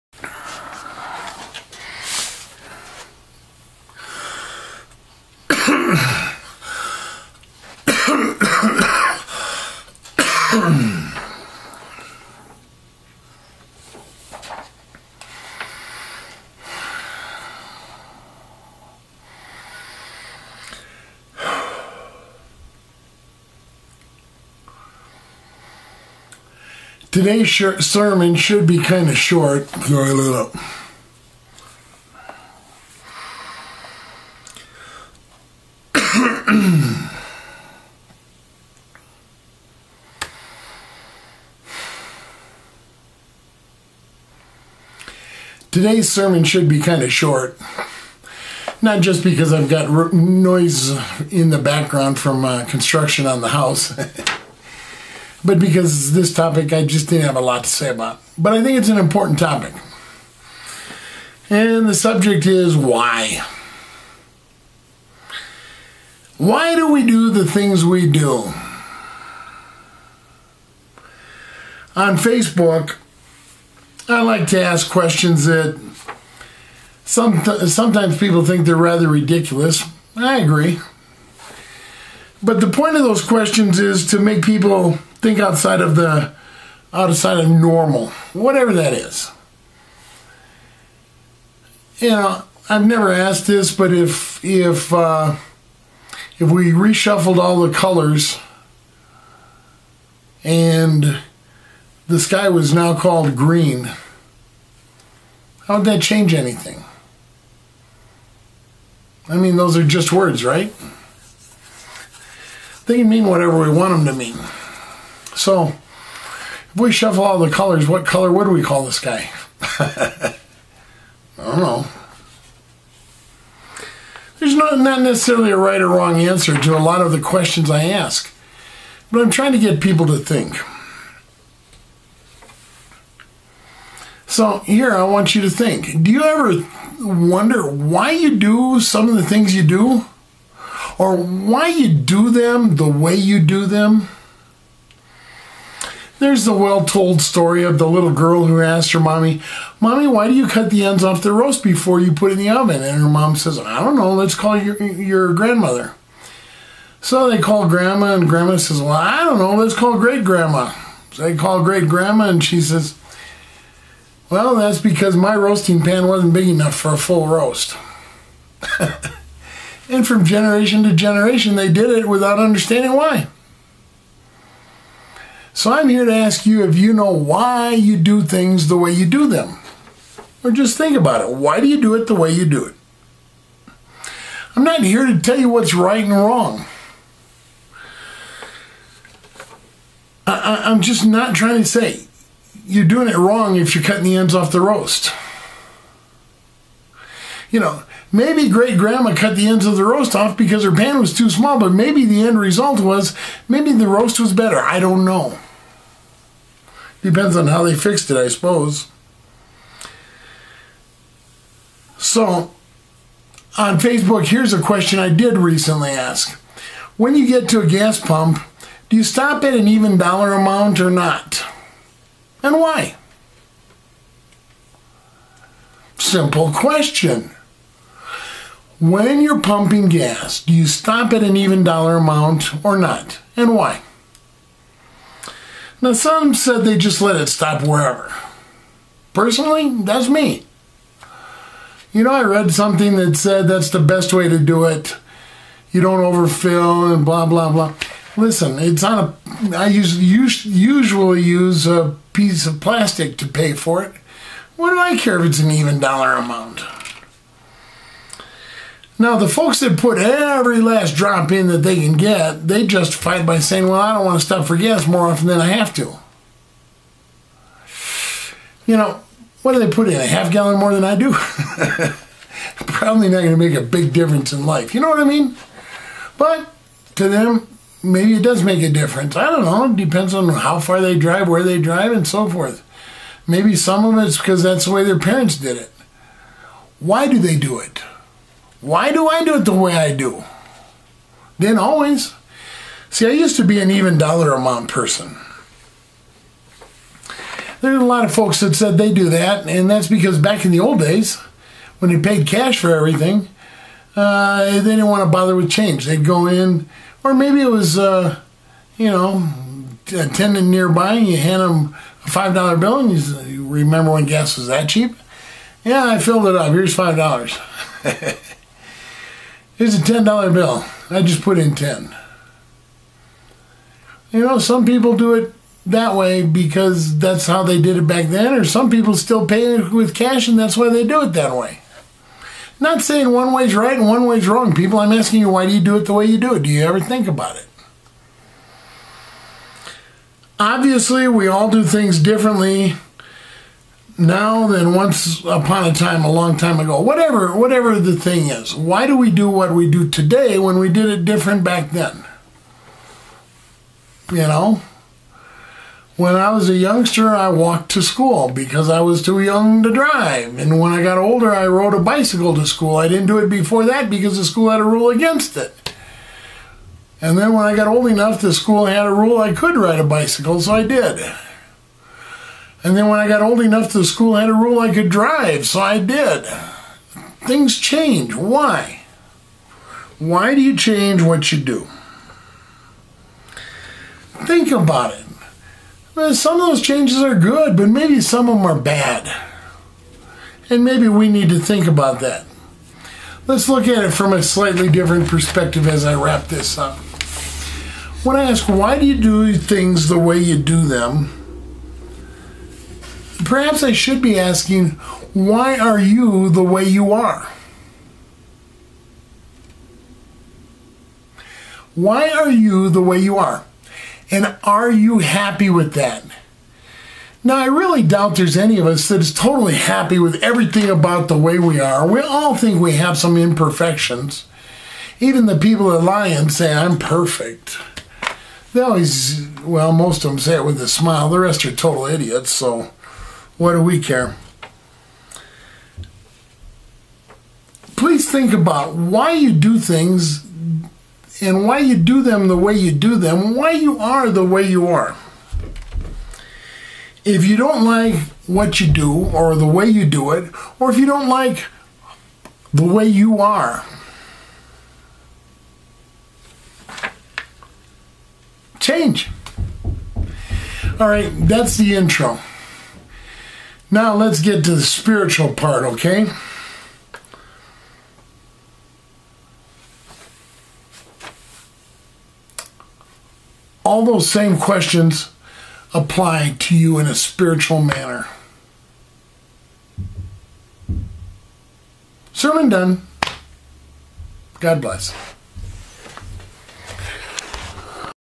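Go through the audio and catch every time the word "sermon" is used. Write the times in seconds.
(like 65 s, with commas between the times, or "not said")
27 s, 46 s, 482 s.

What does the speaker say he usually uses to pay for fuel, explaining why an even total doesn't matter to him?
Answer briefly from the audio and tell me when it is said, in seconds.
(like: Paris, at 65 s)
A piece of plastic, at 251 s.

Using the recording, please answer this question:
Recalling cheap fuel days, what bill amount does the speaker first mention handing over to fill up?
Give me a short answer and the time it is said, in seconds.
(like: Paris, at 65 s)
5 dollars, at 312 s.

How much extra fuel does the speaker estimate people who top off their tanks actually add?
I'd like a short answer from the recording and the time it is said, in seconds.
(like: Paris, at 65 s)
A half gallon, at 269 s.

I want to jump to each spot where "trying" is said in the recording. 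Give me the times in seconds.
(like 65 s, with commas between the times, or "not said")
129 s, 191 s.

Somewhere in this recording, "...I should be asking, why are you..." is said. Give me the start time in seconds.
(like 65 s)
403 s.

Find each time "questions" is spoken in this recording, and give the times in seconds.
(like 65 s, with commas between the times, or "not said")
74 s, 83 s, 127 s, 214 s, 226 s, 474 s.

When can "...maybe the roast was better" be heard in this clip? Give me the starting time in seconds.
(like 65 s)
203 s.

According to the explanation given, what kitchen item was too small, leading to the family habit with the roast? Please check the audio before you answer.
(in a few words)
Roasting pan.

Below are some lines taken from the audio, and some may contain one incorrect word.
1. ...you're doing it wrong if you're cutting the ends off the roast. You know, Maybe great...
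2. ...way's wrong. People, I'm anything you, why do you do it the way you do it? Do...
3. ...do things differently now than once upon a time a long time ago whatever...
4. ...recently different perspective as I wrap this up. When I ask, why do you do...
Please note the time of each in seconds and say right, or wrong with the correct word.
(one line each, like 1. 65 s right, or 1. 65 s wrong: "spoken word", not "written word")
1. 192 s right
2. 334 s wrong: "asking", not "anything"
3. 341 s right
4. 394 s wrong: "slightly", not "recently".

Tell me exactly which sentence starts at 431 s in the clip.
The rest are total idiots, so what do we care?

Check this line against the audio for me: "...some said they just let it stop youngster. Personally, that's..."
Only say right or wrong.
wrong.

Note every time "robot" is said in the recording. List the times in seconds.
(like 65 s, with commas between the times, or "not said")
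not said.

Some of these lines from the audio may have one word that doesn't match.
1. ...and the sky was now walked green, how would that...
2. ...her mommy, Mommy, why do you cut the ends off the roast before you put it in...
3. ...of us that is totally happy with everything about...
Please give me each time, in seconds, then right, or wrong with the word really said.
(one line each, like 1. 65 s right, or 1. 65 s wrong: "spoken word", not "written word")
1. 100 s wrong: "called", not "walked"
2. 148 s right
3. 418 s right.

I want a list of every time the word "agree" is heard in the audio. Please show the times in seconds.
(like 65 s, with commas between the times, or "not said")
80 s.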